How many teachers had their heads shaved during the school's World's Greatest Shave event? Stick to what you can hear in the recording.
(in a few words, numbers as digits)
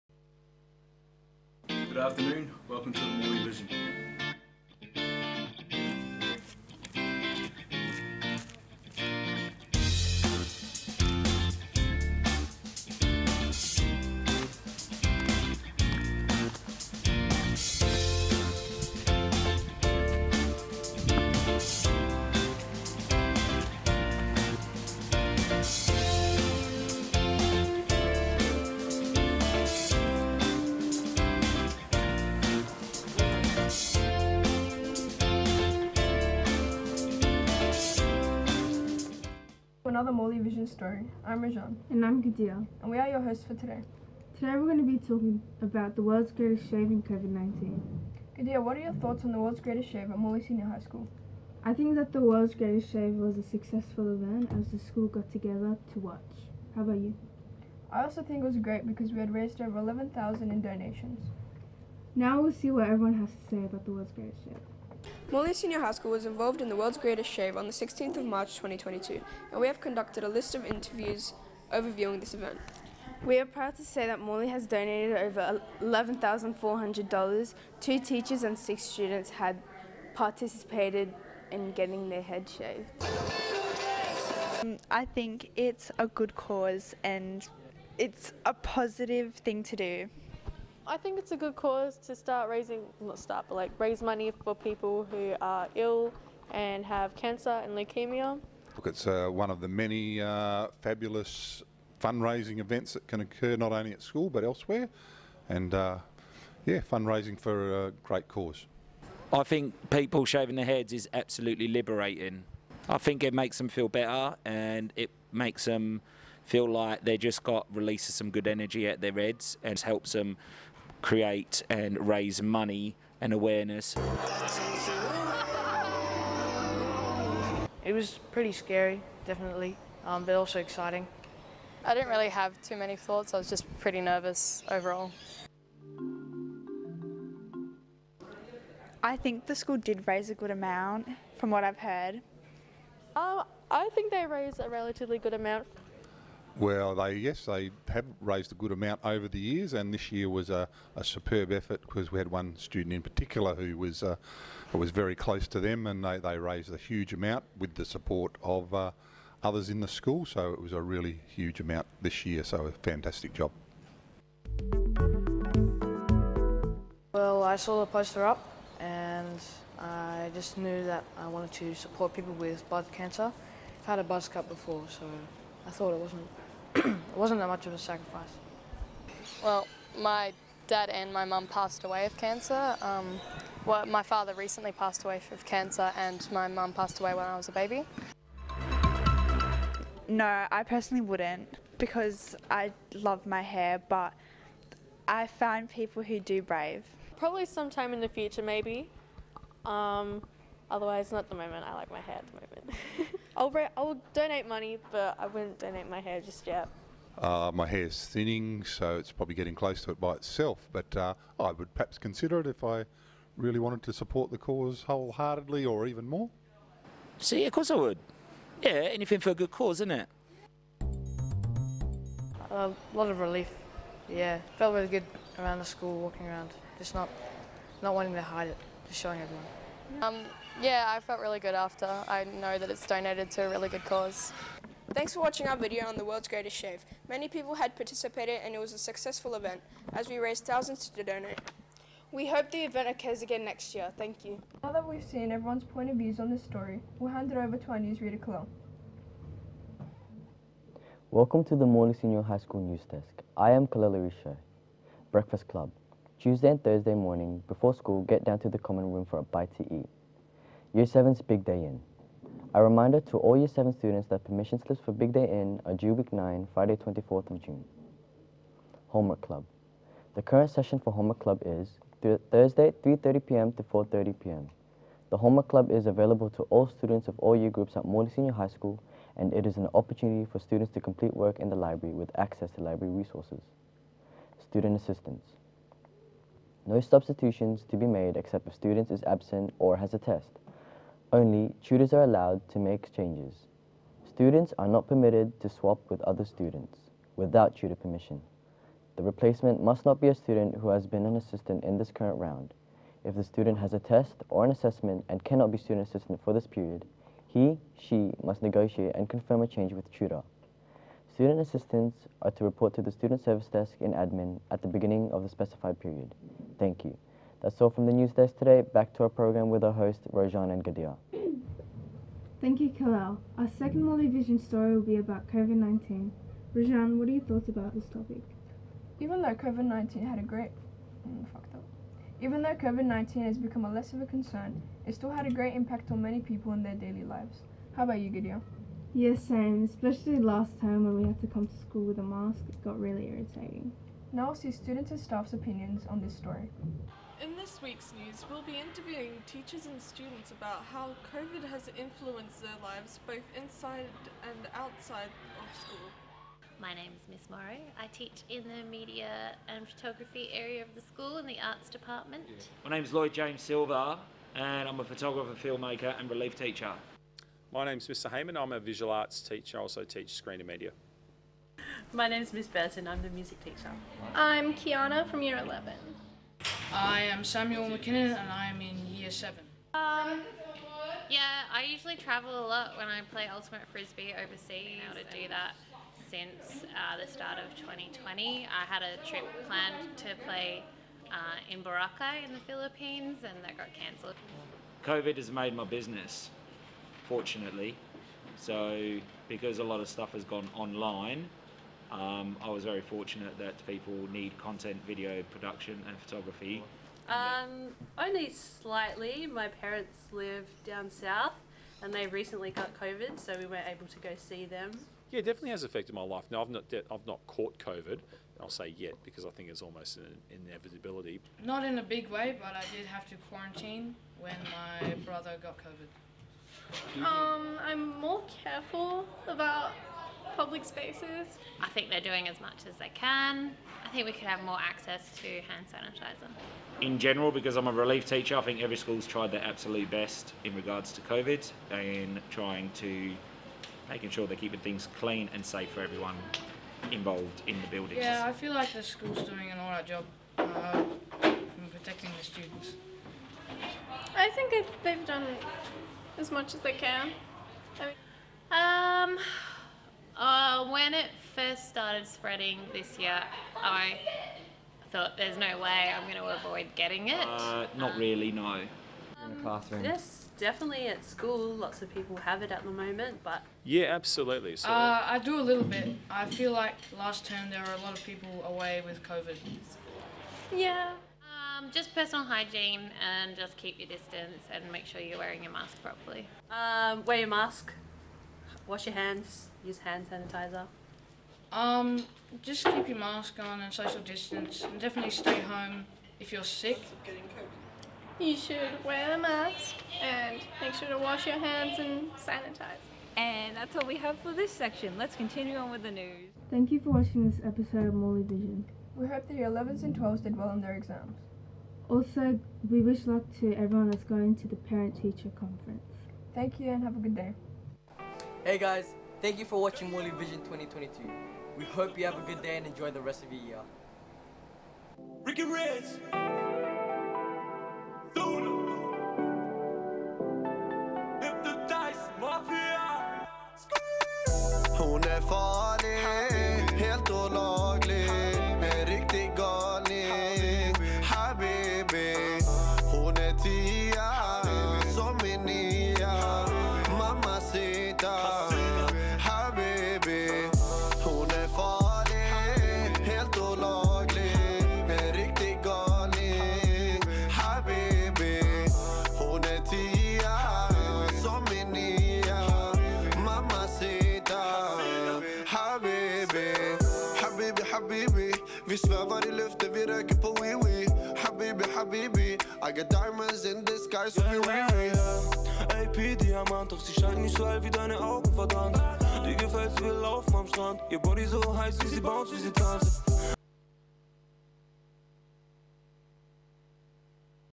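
2.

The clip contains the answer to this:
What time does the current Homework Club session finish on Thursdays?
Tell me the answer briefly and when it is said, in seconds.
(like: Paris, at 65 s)
4.30 p.m., at 273 s.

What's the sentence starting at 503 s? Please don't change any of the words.
And that's all we have for this section.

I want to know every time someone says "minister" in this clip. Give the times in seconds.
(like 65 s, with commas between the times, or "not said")
not said.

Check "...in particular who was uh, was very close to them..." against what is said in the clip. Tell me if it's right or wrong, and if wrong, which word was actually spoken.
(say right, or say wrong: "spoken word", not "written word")
right.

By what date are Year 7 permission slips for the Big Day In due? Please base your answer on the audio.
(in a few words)
Friday 24th of June.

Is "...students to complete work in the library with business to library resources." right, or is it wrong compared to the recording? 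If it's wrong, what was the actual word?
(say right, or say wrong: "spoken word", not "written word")
wrong: "access", not "business".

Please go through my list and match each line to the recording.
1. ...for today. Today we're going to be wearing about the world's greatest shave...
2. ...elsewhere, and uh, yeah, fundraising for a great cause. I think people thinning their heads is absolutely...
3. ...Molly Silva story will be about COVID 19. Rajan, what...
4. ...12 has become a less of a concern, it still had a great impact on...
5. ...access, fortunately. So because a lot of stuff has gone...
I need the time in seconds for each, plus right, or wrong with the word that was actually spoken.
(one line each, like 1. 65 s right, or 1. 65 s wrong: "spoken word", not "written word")
1. 43 s wrong: "talking", not "wearing"
2. 104 s wrong: "shaving", not "thinning"
3. 323 s wrong: "Vision", not "Silva"
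4. 332 s wrong: "19", not "12"
5. 395 s wrong: "business", not "access".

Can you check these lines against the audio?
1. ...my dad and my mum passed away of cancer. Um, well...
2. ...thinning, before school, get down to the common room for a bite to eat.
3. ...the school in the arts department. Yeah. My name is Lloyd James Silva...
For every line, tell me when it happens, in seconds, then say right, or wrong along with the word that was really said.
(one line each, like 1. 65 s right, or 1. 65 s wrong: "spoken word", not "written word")
1. 179 s right
2. 256 s wrong: "morning", not "thinning"
3. 360 s right.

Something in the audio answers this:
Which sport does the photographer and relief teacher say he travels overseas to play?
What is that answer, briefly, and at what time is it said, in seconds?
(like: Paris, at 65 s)
Ultimate Frisbee, at 383 s.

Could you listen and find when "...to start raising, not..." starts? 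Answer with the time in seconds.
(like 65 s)
91 s.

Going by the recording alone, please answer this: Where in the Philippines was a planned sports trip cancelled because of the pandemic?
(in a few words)
Boracay.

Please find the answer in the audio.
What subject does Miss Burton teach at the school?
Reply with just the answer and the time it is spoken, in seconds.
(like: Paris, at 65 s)
music, at 373 s.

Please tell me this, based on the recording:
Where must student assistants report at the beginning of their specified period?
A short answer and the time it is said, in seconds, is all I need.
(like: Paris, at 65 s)
student service desk, at 312 s.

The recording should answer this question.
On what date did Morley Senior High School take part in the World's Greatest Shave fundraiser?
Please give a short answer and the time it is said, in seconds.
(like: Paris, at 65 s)
16th of March 2022, at 67 s.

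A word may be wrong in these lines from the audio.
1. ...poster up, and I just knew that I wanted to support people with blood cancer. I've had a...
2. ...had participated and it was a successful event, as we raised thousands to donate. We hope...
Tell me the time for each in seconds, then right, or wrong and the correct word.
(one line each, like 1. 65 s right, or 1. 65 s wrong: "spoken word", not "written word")
1. 167 s right
2. 237 s right.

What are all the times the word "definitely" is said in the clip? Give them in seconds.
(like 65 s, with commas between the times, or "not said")
129 s, 415 s, 470 s, 494 s.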